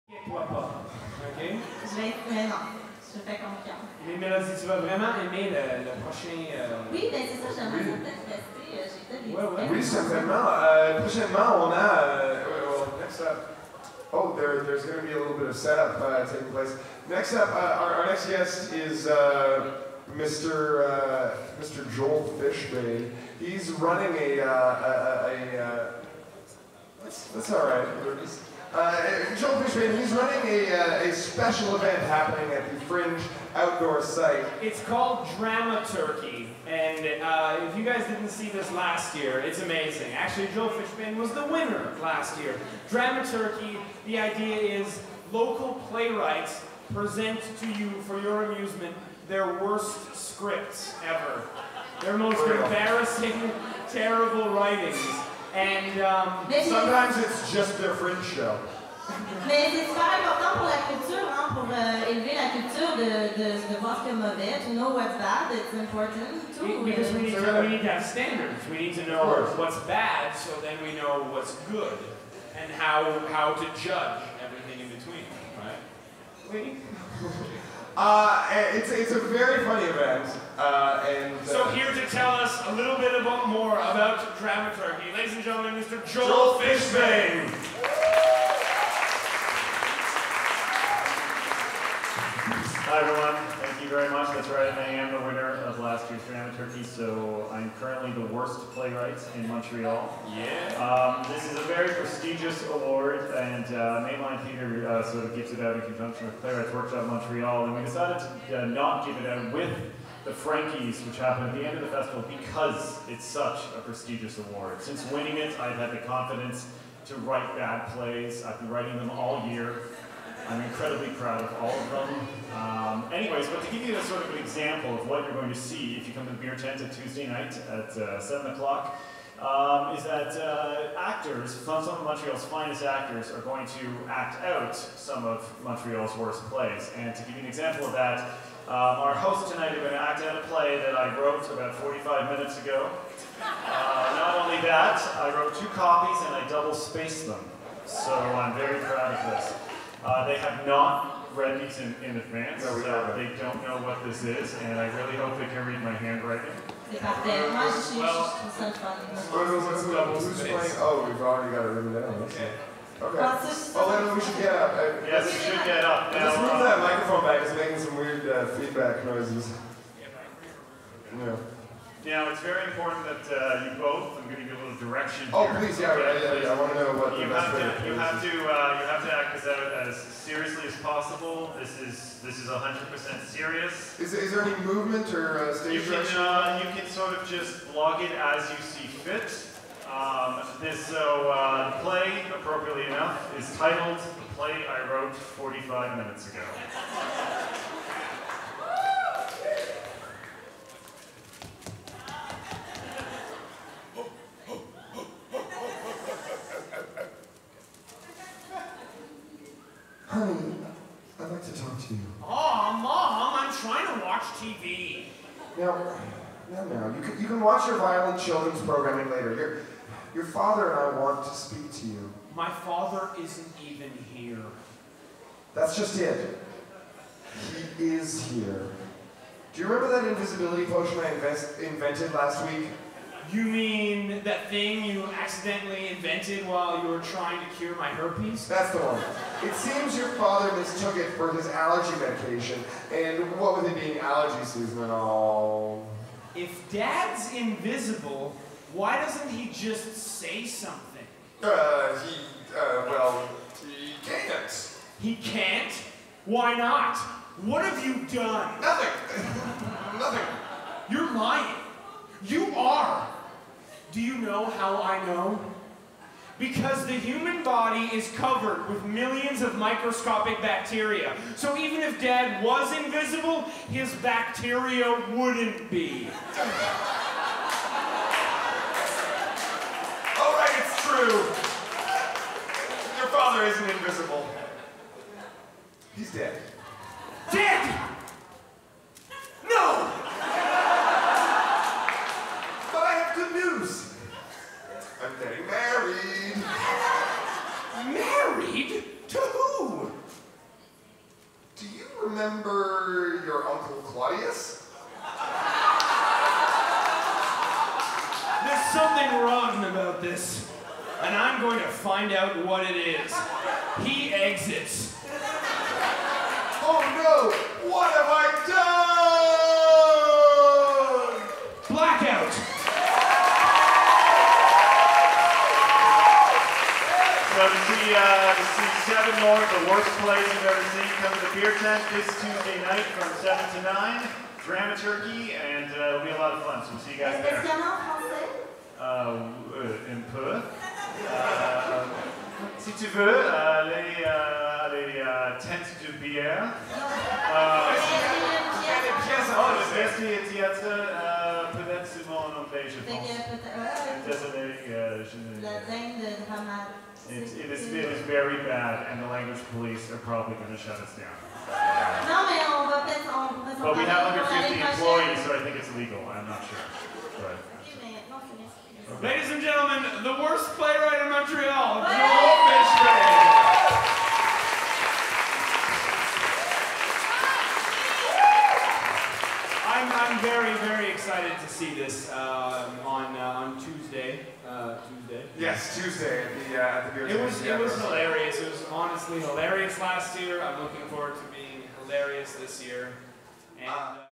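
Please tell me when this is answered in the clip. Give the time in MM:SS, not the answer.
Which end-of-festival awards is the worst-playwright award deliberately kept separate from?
01:50.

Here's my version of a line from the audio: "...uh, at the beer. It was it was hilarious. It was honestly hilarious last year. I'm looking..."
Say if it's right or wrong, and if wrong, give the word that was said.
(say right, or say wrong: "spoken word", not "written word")
right.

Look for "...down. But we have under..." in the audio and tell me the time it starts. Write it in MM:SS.
06:00.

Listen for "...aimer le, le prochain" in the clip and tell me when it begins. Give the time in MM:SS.
00:05.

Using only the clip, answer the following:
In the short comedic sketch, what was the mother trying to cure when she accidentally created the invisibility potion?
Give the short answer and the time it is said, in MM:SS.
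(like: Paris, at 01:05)
herpes, at 03:57.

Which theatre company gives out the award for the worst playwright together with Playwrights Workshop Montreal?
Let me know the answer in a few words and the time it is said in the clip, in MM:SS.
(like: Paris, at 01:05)
Mainline Theatre, at 01:44.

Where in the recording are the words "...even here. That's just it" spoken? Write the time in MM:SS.
03:43.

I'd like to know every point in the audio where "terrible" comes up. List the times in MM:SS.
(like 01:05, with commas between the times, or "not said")
00:53.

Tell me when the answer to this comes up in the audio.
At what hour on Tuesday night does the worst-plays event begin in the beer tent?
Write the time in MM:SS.
02:08.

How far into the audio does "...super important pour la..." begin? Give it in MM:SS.
00:59.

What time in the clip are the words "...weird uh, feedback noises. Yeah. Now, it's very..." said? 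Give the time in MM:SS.
02:47.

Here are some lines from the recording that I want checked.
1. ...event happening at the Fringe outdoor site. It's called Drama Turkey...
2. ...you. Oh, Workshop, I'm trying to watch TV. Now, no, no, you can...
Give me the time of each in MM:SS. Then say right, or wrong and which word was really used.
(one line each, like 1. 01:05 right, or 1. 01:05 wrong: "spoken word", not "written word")
1. 00:31 right
2. 03:31 wrong: "Mom", not "Workshop".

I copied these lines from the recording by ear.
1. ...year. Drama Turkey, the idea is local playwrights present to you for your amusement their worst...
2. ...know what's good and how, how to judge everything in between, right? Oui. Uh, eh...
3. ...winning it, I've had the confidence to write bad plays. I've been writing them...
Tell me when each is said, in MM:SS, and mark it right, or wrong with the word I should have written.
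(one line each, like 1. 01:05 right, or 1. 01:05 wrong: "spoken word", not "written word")
1. 00:42 right
2. 01:10 right
3. 01:55 right.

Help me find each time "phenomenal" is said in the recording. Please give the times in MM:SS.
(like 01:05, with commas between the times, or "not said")
not said.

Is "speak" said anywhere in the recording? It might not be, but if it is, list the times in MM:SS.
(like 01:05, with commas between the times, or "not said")
03:41.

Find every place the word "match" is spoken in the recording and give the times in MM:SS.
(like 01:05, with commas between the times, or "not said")
not said.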